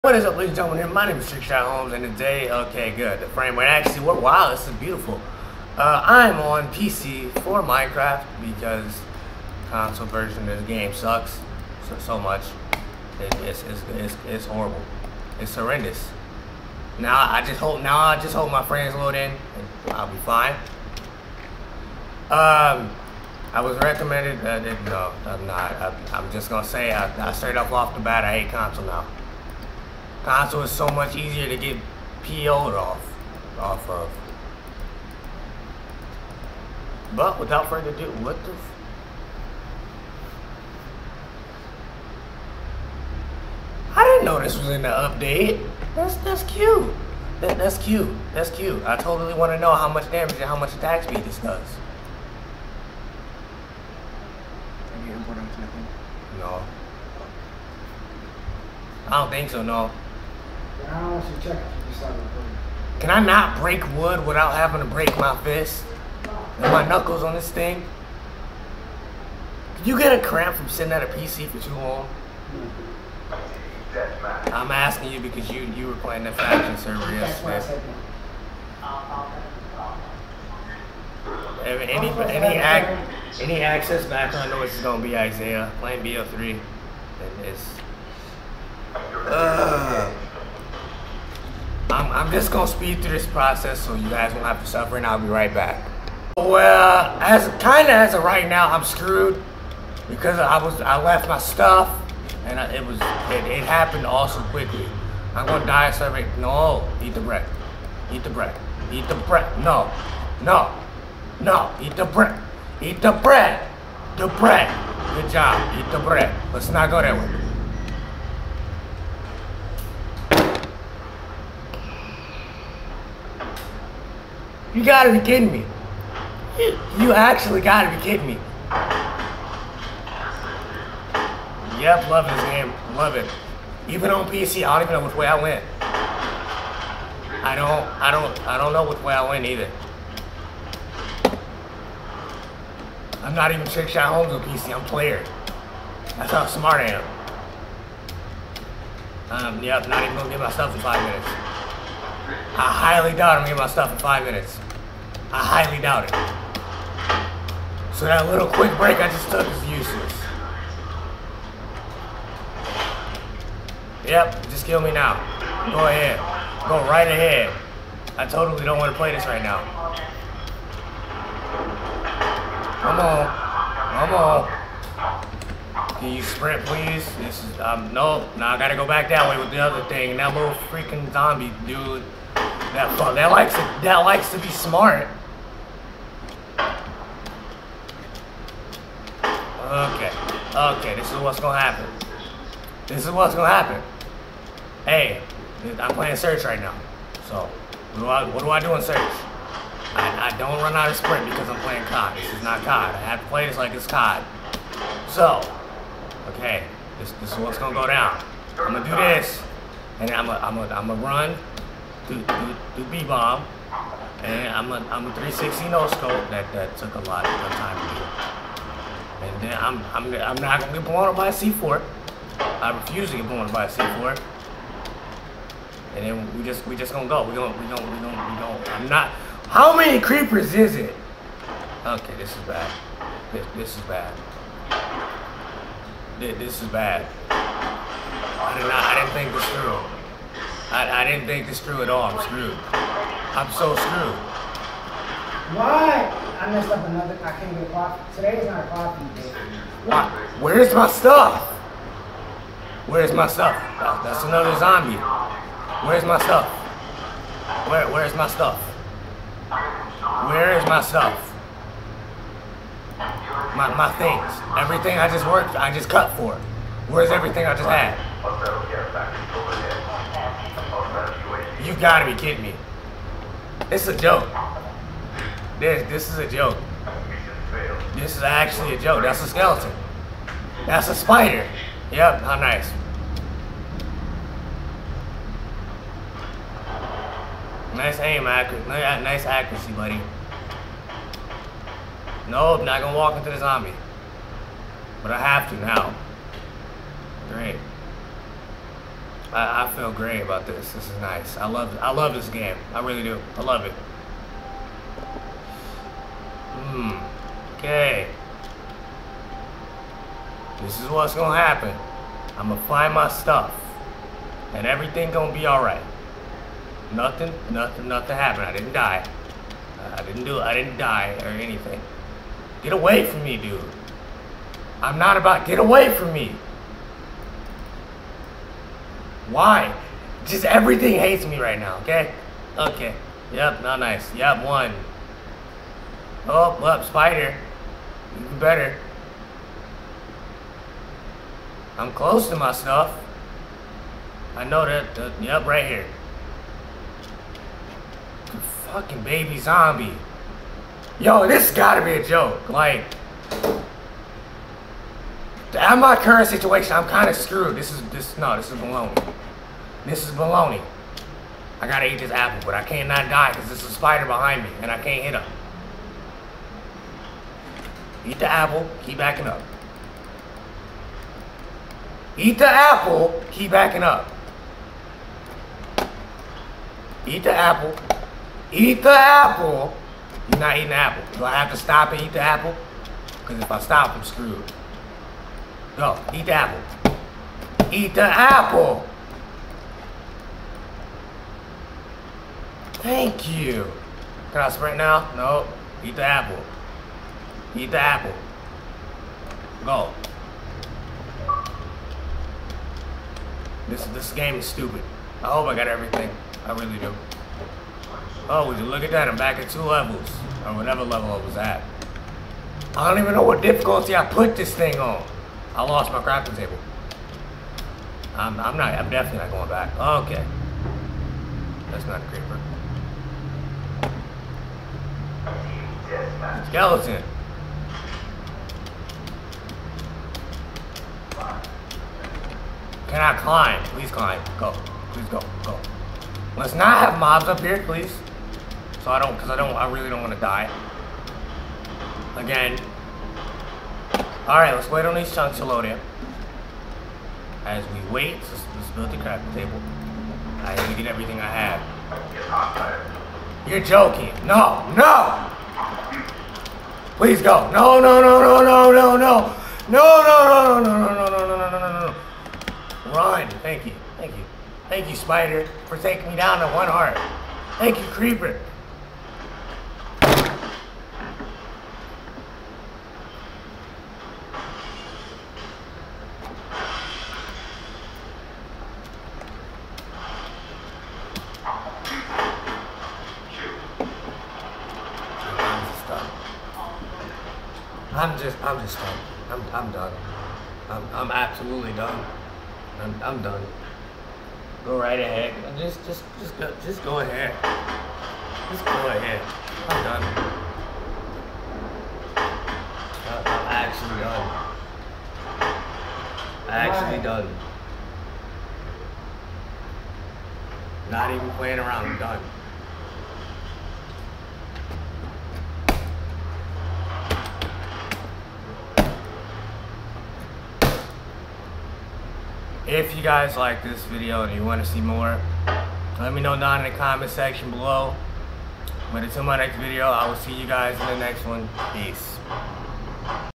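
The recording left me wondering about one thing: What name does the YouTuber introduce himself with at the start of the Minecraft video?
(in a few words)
Trickshot Holmes.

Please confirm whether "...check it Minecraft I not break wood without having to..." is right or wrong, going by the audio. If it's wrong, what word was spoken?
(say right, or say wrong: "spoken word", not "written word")
wrong: "Can", not "Minecraft".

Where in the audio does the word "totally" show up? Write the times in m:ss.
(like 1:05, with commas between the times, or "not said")
0:48, 2:48.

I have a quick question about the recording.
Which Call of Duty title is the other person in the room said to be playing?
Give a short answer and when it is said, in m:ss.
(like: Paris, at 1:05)
BO3, at 1:26.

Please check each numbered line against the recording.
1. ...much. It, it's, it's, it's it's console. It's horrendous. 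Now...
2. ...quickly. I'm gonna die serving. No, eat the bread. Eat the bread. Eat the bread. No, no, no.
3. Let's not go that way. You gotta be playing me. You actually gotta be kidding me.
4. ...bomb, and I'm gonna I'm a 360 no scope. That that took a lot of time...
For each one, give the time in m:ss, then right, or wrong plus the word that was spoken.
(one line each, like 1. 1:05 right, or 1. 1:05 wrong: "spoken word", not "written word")
1. 0:12 wrong: "horrible", not "console"
2. 1:44 right
3. 1:56 wrong: "kidding", not "playing"
4. 3:33 right.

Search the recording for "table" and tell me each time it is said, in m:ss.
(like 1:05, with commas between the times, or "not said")
6:56, 7:29.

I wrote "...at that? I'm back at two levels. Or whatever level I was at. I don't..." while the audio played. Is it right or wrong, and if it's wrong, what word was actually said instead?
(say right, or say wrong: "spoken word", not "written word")
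right.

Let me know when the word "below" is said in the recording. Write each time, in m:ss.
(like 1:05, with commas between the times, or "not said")
8:47.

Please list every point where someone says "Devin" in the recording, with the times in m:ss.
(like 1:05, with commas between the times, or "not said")
not said.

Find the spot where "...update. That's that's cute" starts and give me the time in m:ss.
0:44.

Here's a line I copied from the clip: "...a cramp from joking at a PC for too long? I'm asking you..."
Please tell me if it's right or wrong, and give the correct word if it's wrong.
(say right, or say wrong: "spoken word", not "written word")
wrong: "sitting", not "joking".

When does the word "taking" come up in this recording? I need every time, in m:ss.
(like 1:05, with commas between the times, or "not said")
7:45.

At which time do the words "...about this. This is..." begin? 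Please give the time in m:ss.
5:00.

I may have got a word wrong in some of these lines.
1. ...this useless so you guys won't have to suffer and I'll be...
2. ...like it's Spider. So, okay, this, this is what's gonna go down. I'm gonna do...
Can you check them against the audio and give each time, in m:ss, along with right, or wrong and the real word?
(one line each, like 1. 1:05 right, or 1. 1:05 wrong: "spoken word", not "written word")
1. 1:33 wrong: "process", not "useless"
2. 3:23 wrong: "COD", not "Spider".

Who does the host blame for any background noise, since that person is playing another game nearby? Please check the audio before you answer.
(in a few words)
Isaiah.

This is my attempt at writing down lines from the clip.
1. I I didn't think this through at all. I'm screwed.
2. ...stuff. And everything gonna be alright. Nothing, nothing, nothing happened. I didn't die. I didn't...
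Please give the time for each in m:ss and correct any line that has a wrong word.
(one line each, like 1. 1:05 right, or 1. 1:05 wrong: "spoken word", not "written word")
1. 4:00 right
2. 5:13 right.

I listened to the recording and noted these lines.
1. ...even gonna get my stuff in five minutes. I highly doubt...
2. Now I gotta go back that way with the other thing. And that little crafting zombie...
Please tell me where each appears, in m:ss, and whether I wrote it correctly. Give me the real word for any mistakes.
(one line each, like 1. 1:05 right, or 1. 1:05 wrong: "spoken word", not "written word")
1. 2:30 right
2. 2:58 wrong: "freaking", not "crafting".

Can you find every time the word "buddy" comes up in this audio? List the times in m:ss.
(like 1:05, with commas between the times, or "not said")
4:49.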